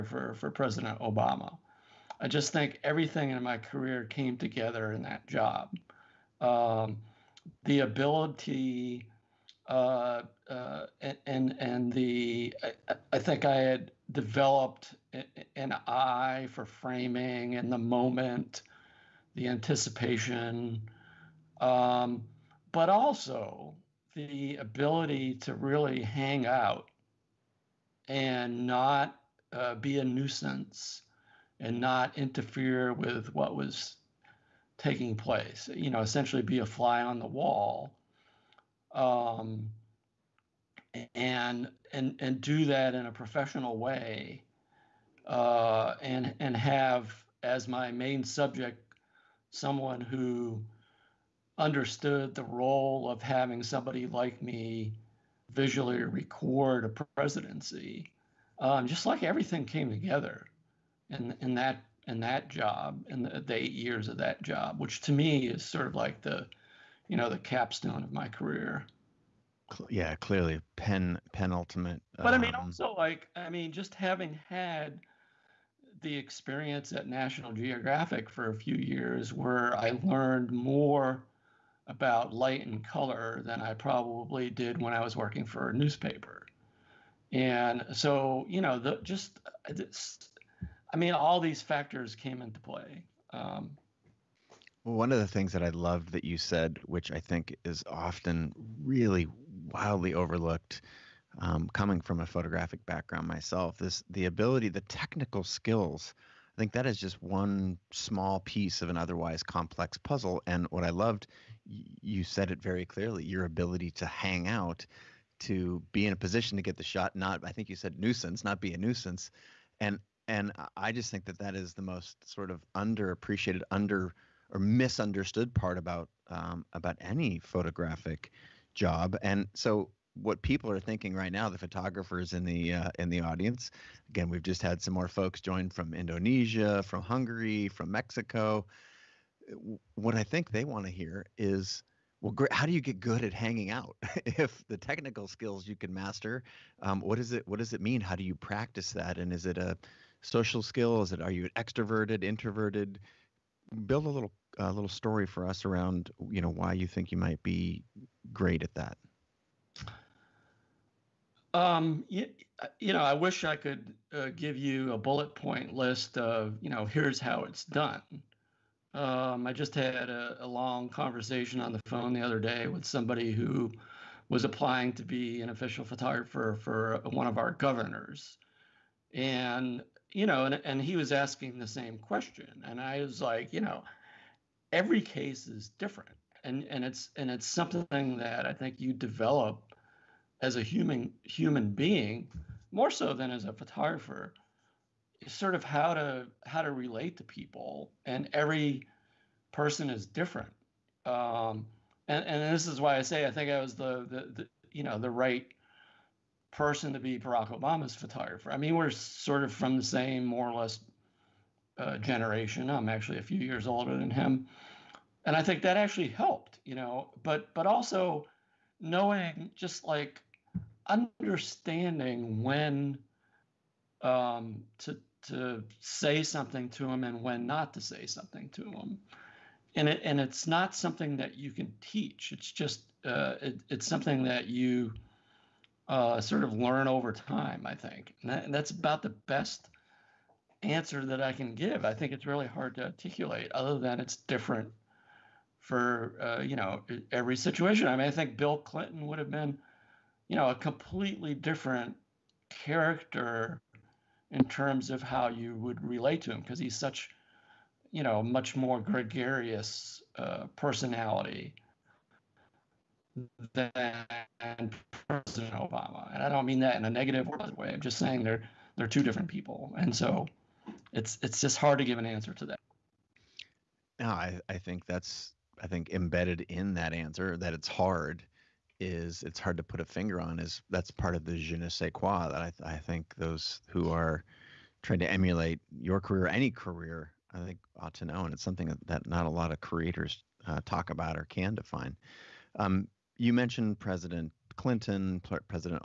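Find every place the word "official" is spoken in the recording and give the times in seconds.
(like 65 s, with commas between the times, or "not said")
175 s.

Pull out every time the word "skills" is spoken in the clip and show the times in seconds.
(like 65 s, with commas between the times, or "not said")
105 s, 145 s, 150 s.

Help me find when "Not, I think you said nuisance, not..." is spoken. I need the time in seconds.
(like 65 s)
117 s.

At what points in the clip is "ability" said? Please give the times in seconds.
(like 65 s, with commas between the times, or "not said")
7 s, 24 s, 104 s, 113 s.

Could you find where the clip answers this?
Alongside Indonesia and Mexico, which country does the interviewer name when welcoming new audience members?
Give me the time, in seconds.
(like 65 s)
137 s.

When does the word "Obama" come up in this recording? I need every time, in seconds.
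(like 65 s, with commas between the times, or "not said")
0 s, 207 s, 265 s.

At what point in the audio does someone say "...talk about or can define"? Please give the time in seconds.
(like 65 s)
290 s.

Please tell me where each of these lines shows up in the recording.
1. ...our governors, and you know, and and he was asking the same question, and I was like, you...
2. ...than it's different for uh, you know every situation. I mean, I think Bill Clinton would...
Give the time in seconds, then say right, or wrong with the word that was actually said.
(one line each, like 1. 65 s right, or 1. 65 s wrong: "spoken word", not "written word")
1. 177 s right
2. 243 s right.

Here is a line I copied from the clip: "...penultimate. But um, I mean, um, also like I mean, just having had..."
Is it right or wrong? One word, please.
right.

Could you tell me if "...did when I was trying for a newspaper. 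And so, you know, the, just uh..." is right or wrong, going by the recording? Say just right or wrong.
wrong.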